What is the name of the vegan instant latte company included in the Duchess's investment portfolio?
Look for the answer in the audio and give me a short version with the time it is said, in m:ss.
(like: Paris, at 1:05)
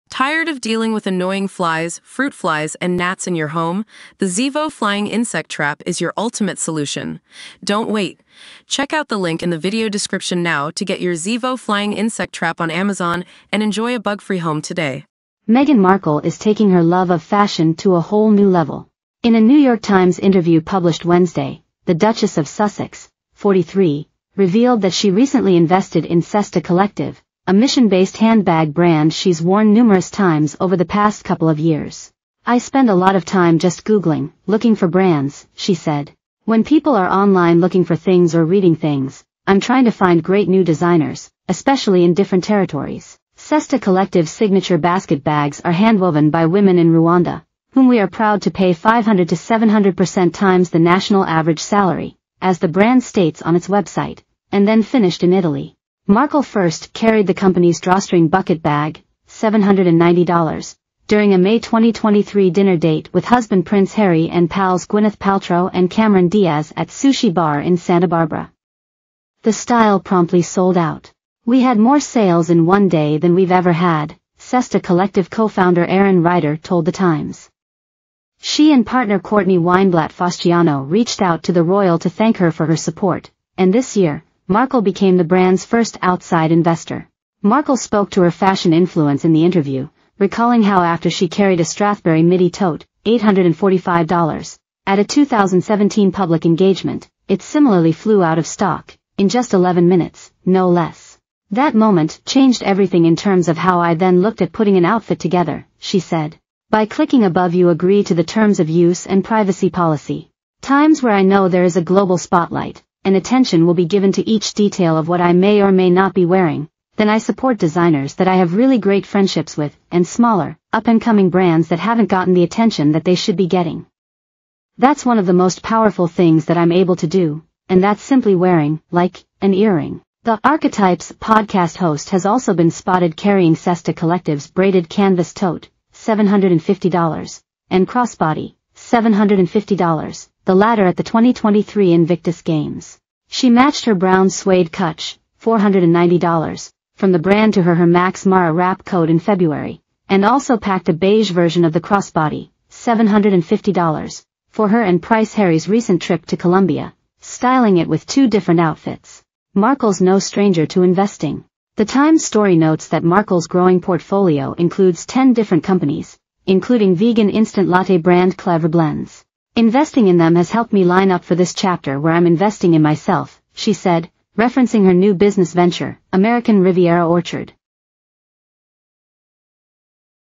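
Clever Blends, at 2:48.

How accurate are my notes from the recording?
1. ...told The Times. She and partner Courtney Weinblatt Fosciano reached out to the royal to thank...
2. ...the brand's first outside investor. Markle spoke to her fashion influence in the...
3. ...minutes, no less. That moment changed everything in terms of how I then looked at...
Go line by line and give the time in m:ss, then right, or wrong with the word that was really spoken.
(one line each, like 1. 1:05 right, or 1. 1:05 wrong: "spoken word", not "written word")
1. 1:16 right
2. 1:25 right
3. 1:39 right.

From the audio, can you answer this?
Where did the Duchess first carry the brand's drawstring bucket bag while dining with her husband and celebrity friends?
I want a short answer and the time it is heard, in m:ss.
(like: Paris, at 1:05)
Sushi Bar in Santa Barbara, at 1:06.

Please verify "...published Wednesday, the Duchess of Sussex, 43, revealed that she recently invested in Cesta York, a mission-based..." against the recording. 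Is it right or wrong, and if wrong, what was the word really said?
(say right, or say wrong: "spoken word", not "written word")
wrong: "Collective", not "York".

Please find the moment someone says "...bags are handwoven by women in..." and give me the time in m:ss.
0:45.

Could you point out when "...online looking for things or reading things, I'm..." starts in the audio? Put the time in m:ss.
0:37.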